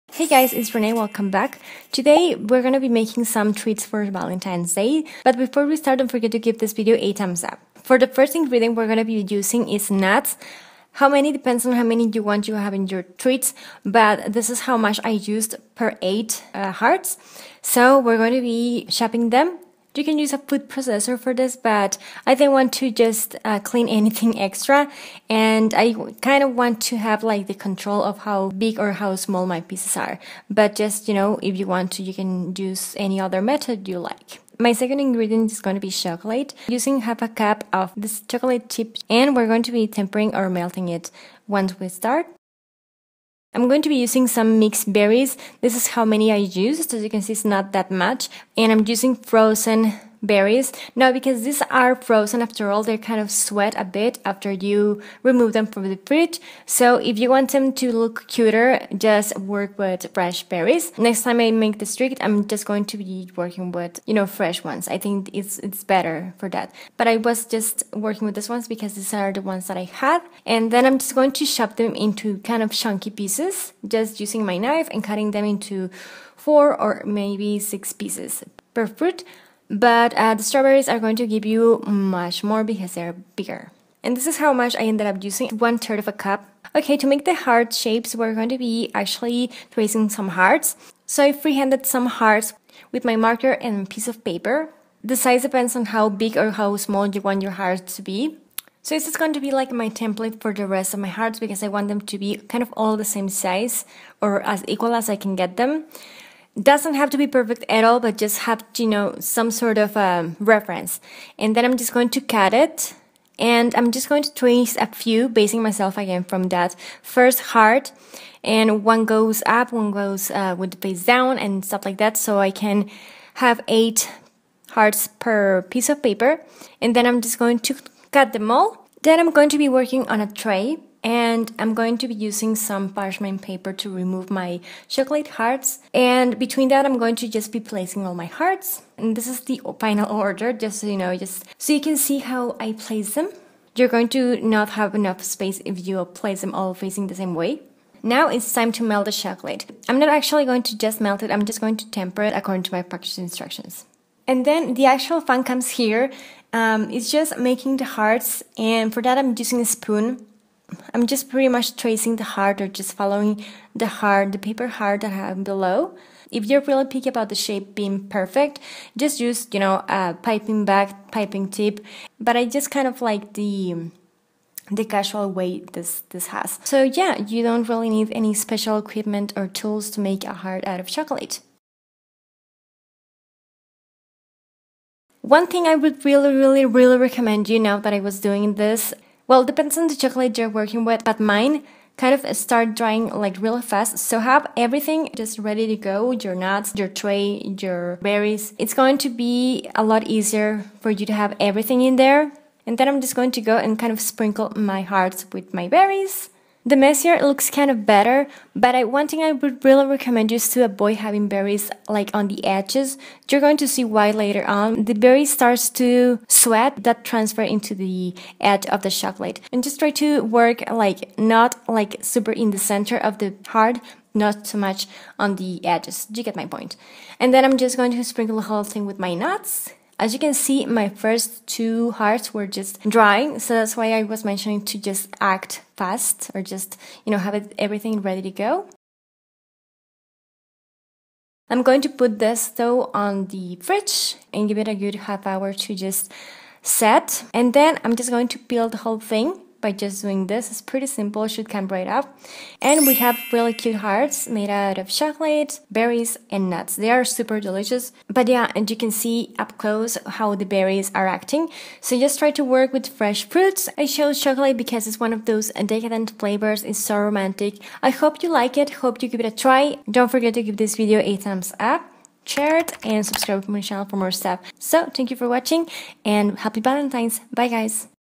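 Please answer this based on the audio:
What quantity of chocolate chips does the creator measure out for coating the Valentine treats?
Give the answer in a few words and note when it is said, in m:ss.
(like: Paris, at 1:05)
half a cup, at 0:37.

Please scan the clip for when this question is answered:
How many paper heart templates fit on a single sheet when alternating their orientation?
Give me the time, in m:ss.
2:03.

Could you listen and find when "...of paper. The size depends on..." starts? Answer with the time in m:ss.
1:34.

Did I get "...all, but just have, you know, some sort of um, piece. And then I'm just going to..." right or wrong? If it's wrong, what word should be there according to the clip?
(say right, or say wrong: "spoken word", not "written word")
wrong: "reference", not "piece".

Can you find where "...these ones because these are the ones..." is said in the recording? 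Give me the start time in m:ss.
1:08.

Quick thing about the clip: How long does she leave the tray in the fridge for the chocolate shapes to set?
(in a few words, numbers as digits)
half hour.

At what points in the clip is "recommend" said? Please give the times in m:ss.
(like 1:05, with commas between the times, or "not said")
3:06, 3:29.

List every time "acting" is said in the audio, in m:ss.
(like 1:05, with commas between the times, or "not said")
4:21.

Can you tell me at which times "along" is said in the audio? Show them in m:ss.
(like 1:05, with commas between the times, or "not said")
not said.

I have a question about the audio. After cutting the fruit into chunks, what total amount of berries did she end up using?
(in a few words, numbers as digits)
1/3 of a cup.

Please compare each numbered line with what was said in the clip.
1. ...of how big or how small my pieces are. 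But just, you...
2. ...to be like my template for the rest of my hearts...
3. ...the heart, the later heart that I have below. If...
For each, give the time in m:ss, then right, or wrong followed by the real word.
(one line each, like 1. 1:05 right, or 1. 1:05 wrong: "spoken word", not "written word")
1. 0:28 right
2. 1:39 right
3. 2:43 wrong: "paper", not "later".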